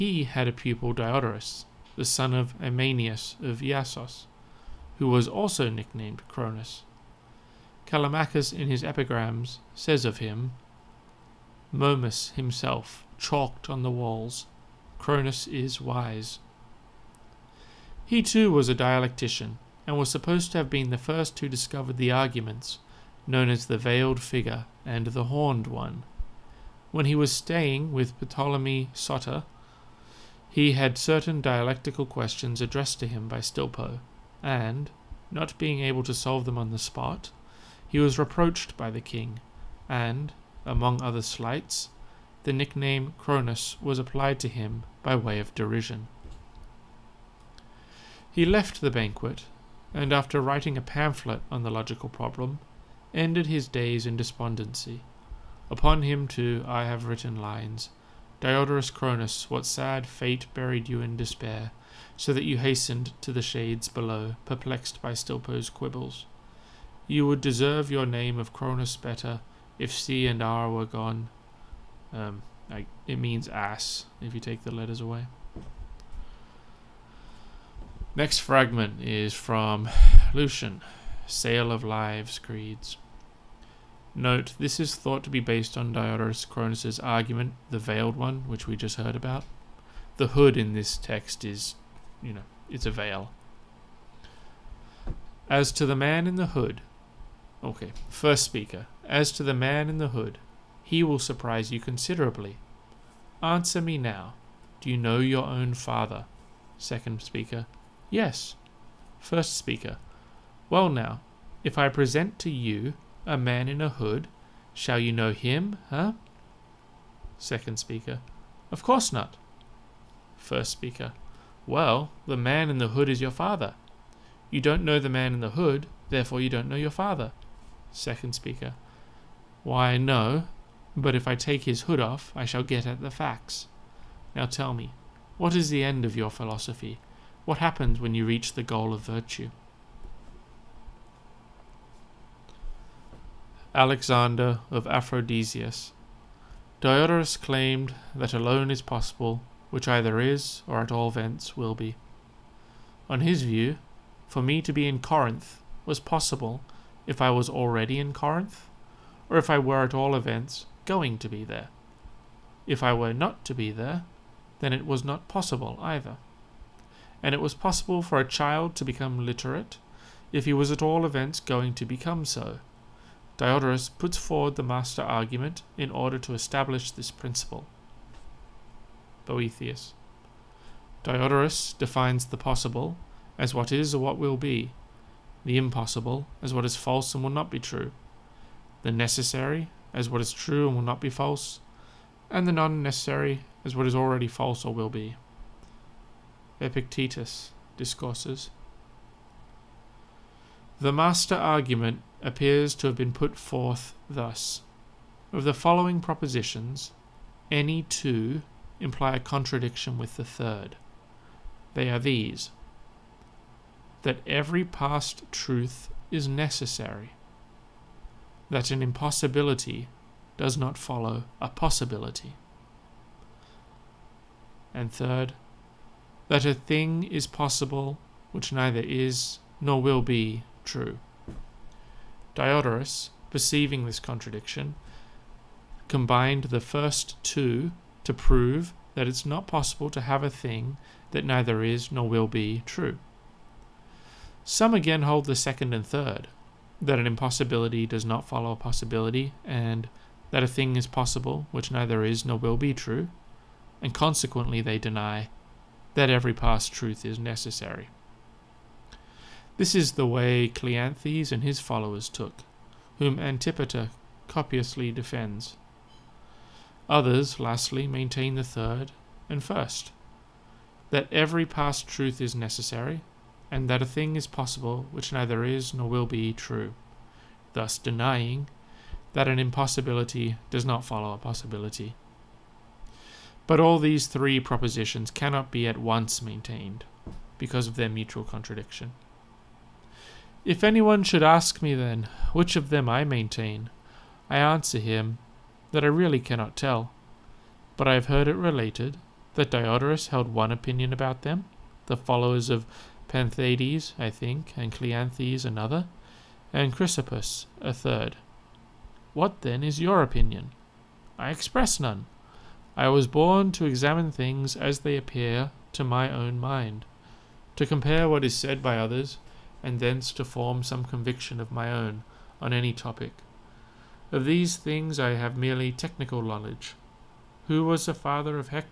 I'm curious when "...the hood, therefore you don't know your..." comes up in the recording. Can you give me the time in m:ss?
2:05.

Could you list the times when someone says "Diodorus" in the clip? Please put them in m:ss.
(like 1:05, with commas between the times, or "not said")
0:00, 0:58, 1:25, 2:26, 2:53, 3:01, 3:52, 4:59.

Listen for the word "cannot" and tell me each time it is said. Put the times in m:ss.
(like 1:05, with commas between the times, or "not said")
4:45, 4:56.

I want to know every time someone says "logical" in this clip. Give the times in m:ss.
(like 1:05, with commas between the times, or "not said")
0:51.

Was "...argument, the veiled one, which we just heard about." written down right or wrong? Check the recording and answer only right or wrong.
right.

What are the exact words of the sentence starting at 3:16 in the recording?
Epictetus discourses the master argument appears to have been put forth thus.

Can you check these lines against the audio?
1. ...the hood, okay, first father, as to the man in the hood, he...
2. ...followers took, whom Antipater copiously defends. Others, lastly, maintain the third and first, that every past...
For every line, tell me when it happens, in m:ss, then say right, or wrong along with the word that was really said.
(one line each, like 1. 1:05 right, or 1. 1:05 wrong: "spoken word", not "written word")
1. 1:36 wrong: "speaker", not "father"
2. 4:21 right.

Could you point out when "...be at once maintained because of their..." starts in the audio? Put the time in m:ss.
4:45.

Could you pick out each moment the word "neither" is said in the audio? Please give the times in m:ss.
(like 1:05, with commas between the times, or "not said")
3:48, 4:01, 4:11, 4:35.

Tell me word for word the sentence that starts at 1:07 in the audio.
You would deserve your name of Cronus better if C and R were gone.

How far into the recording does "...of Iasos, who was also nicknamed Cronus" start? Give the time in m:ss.
0:03.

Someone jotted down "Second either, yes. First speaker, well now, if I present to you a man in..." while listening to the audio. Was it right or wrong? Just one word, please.
wrong.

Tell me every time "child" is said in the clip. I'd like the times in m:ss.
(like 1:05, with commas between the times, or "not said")
2:48.